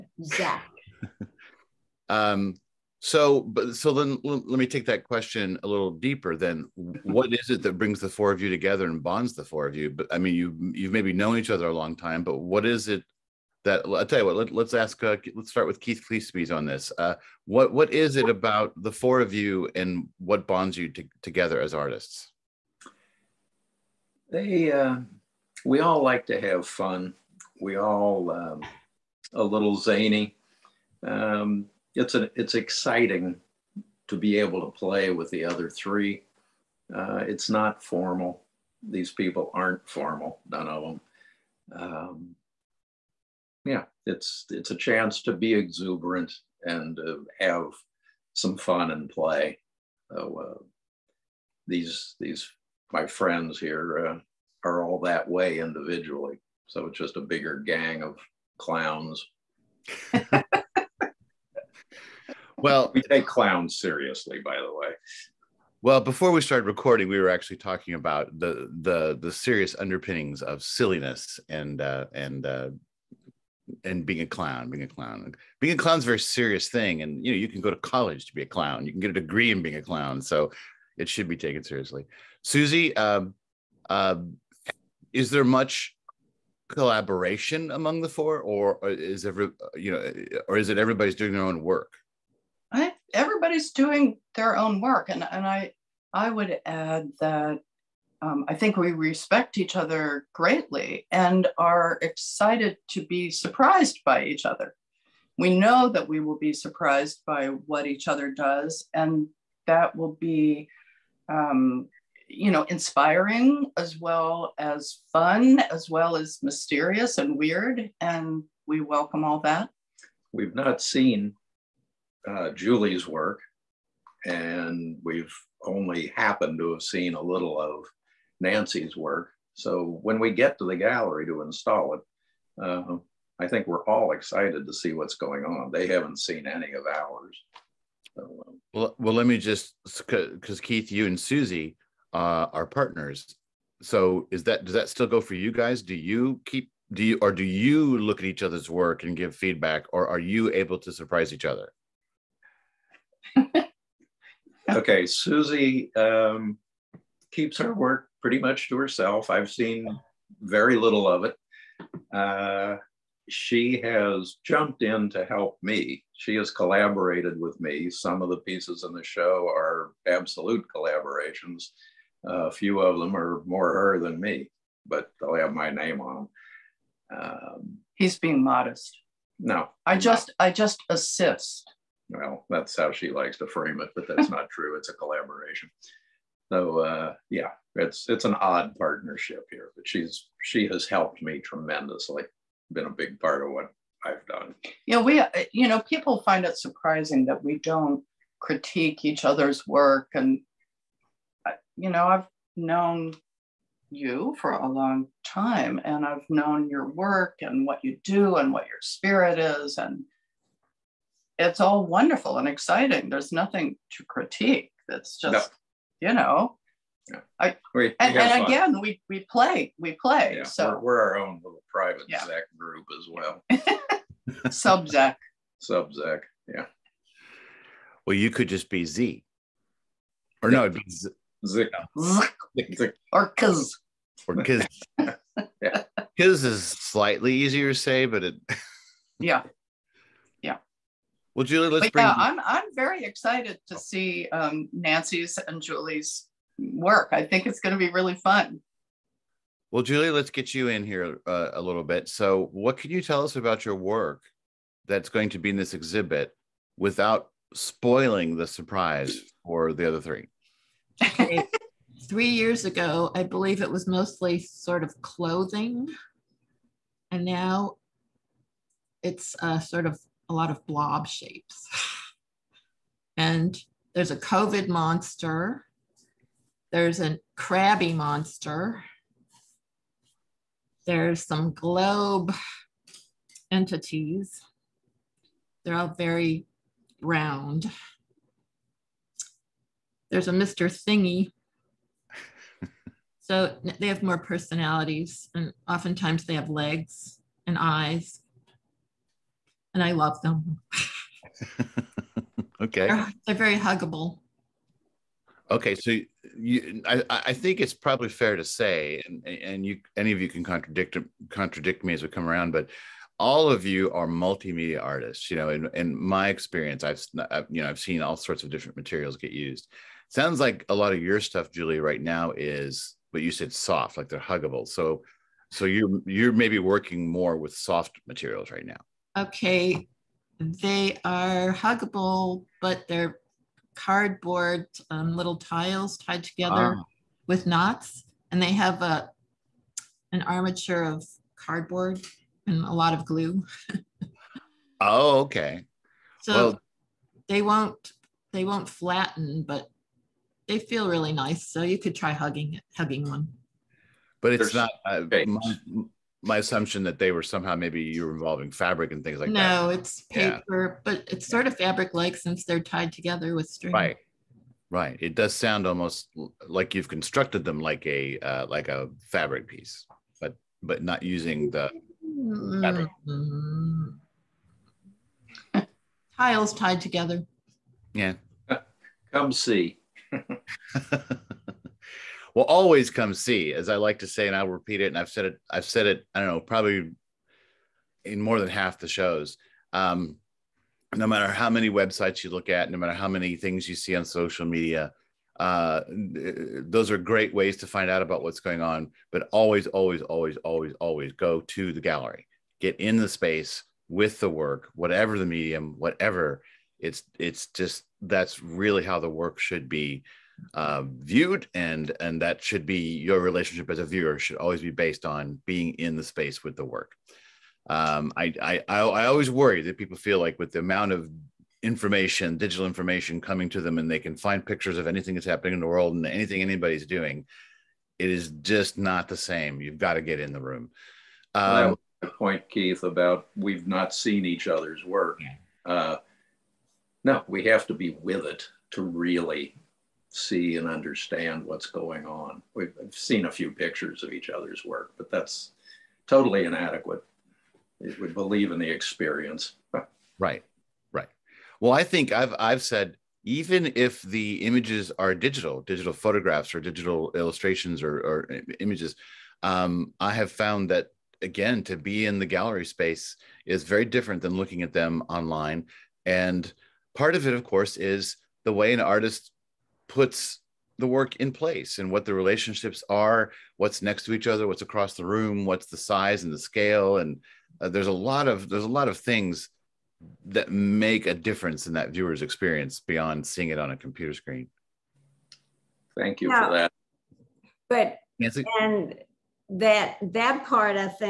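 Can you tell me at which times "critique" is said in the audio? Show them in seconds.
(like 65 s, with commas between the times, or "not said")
198 s, 214 s.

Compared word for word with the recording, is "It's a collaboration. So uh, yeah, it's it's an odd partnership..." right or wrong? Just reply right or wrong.
right.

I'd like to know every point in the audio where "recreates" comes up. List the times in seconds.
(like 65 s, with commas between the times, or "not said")
not said.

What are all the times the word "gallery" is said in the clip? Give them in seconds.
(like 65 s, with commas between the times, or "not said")
130 s, 401 s, 462 s.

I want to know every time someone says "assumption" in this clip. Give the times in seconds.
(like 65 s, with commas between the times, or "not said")
356 s.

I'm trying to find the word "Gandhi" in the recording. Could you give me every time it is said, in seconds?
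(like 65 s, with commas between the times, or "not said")
not said.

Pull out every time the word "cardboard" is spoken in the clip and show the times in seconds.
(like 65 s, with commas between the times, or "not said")
333 s, 341 s.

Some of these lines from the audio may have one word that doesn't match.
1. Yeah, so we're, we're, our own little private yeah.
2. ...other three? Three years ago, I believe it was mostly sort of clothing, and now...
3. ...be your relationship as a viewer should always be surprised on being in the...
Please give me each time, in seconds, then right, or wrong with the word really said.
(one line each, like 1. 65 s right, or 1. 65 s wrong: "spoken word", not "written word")
1. 220 s right
2. 259 s right
3. 412 s wrong: "based", not "surprised".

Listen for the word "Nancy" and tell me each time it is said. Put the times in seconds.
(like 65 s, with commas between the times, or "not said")
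128 s, 244 s, 488 s.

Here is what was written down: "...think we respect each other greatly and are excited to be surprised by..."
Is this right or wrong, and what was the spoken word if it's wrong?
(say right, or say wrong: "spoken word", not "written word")
right.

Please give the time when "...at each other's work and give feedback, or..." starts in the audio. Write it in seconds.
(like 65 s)
148 s.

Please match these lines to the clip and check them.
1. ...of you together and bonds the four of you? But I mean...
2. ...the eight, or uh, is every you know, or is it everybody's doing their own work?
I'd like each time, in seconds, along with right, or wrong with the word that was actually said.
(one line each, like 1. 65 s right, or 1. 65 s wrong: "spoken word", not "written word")
1. 8 s right
2. 88 s wrong: "four", not "eight".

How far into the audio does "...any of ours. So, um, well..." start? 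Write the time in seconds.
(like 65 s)
136 s.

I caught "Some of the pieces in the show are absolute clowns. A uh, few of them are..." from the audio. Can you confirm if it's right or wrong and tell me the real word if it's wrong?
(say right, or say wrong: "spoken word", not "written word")
wrong: "collaborations", not "clowns".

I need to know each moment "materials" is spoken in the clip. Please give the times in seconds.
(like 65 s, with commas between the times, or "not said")
318 s, 328 s.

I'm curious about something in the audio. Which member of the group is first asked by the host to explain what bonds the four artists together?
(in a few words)
Keith Kleespies.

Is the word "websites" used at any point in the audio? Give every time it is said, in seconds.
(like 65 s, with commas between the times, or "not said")
391 s.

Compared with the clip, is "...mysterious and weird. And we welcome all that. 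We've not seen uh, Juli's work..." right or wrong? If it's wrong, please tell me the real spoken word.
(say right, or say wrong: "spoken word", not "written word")
right.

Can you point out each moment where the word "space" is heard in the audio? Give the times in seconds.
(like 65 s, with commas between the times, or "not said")
403 s, 416 s, 462 s.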